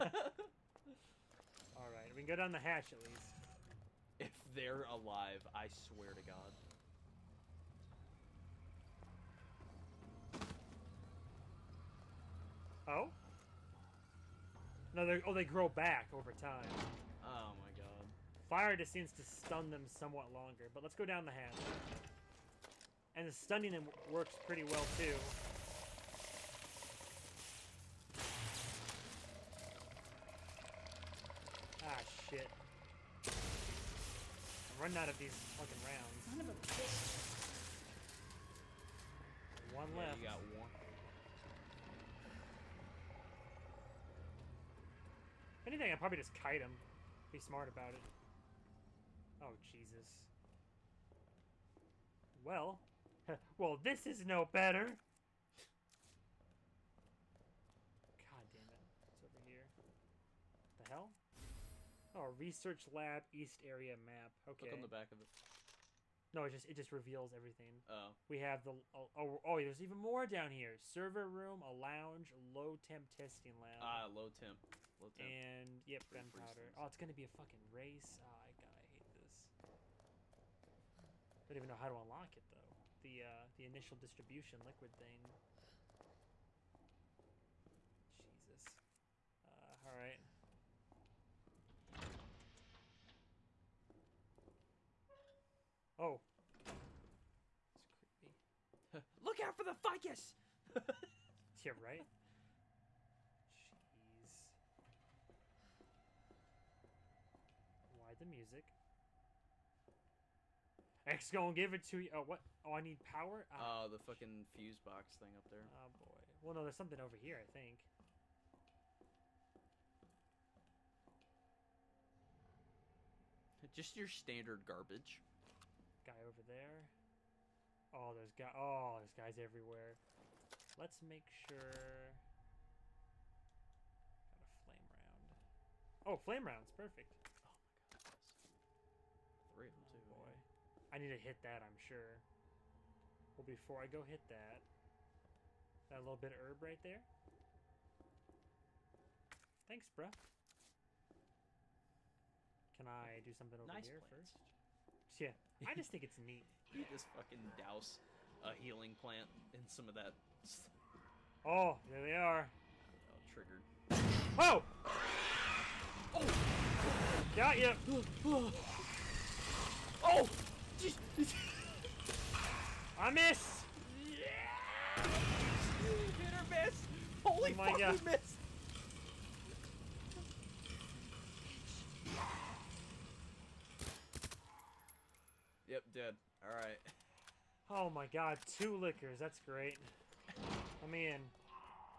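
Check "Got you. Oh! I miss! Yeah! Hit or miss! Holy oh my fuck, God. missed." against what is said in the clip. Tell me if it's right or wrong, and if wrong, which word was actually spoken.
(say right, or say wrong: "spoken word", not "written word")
right.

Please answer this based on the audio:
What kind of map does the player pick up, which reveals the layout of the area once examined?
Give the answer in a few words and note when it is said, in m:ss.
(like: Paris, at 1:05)
Research lab east area map, at 1:02.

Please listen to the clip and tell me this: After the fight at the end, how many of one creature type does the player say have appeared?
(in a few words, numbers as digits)
2.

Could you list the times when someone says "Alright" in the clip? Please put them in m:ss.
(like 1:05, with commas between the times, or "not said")
0:01, 3:06.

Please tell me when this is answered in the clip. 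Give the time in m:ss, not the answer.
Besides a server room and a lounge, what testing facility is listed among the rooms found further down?
1:12.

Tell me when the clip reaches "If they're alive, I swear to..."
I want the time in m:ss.
0:04.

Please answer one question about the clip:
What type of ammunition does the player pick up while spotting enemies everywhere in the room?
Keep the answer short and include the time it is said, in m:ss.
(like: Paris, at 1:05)
Flame rounds, at 2:16.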